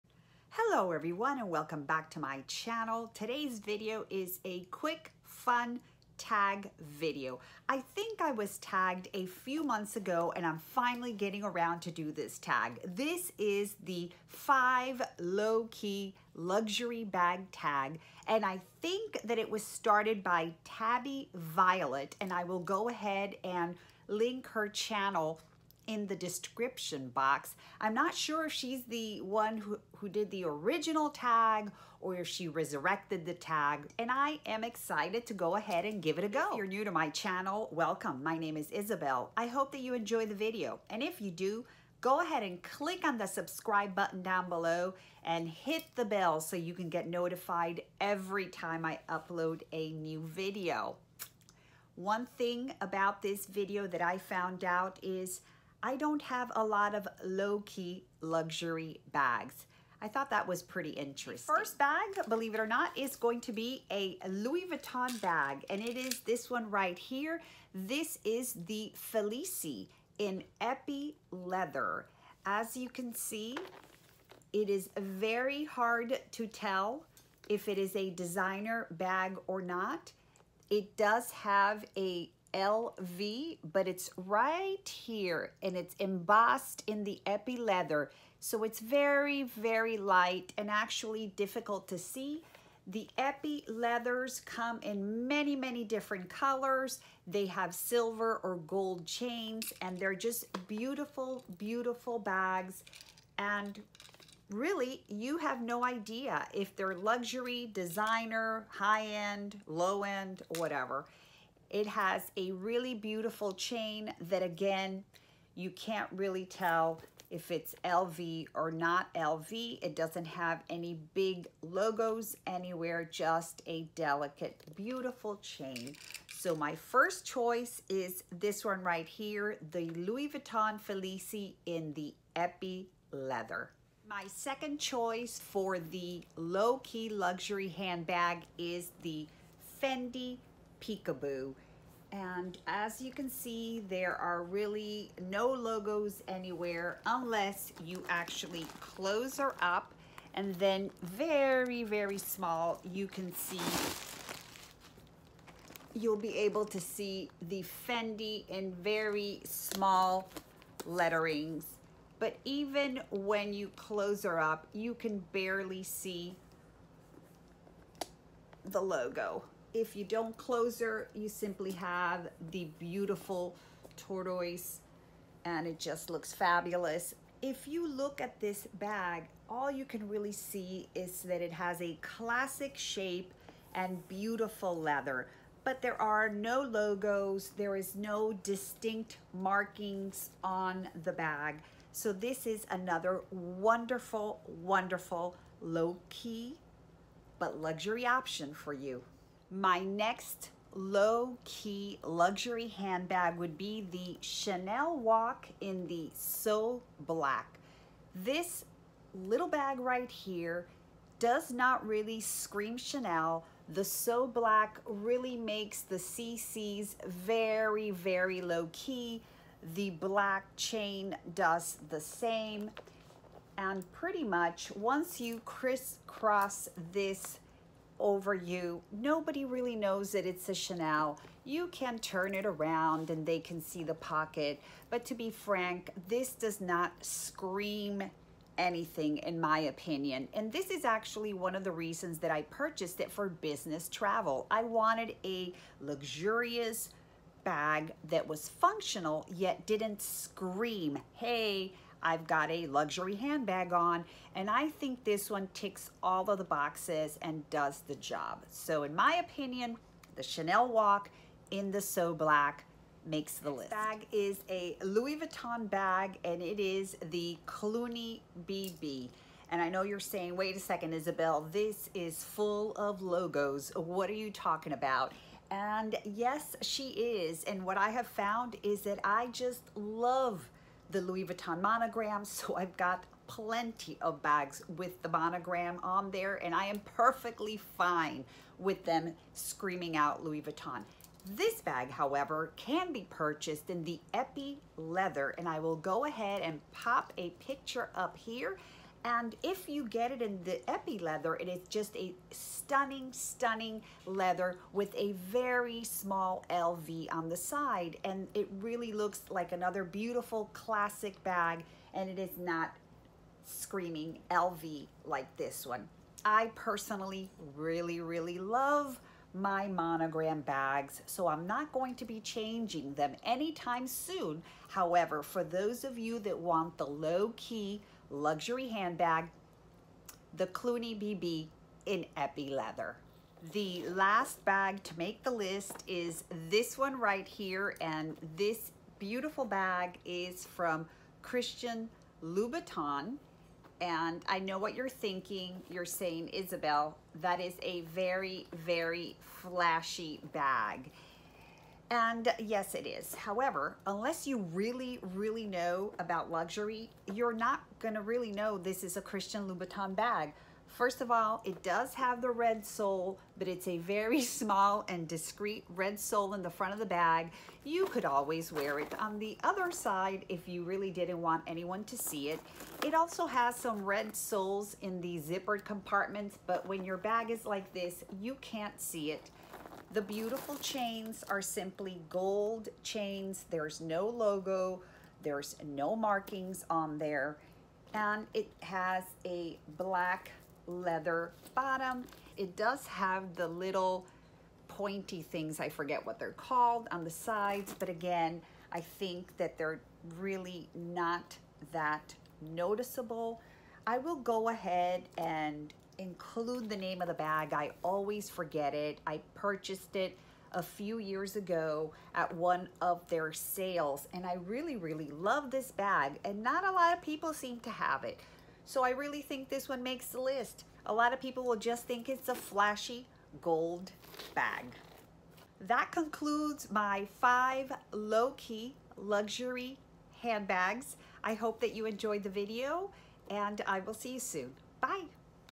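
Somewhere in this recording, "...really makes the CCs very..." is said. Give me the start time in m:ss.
3:34.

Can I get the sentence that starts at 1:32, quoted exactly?
The epi leathers come in many, many different colors.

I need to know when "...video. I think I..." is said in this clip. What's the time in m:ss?
0:06.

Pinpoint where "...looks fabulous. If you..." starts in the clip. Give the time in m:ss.
2:56.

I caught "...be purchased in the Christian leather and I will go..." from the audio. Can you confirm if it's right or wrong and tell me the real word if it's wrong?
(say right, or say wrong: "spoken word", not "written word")
wrong: "Epi", not "Christian".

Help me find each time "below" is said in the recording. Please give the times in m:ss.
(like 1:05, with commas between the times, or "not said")
0:44.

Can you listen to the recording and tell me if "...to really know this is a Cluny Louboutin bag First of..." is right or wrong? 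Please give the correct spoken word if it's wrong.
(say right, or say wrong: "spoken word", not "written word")
wrong: "Christian", not "Cluny".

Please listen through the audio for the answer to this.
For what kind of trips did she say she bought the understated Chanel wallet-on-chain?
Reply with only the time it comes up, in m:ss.
4:03.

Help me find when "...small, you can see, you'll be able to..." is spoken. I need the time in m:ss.
2:32.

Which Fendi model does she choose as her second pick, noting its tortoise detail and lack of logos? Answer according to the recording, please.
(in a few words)
Peekaboo.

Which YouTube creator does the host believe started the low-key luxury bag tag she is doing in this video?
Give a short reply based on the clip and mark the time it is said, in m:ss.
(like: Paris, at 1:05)
Tabby Violet, at 0:20.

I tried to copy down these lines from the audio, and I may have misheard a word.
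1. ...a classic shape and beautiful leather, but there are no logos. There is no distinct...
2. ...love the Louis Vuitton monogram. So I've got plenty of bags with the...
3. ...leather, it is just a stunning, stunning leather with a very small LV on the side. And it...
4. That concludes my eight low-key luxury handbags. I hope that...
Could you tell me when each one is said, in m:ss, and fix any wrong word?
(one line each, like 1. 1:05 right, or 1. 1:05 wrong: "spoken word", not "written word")
1. 3:01 right
2. 4:39 right
3. 5:00 right
4. 7:05 wrong: "five", not "eight".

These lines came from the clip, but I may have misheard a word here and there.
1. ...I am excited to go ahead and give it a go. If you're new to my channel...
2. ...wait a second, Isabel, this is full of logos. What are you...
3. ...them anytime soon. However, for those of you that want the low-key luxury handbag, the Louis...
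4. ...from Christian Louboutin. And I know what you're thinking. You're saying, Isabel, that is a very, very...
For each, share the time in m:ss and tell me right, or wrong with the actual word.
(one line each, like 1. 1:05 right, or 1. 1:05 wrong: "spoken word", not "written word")
1. 0:34 right
2. 4:30 right
3. 5:22 wrong: "Cluny", not "Louis"
4. 5:40 right.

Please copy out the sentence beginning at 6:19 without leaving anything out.
The beautiful chains are simply gold chains.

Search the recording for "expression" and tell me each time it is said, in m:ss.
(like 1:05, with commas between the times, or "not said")
not said.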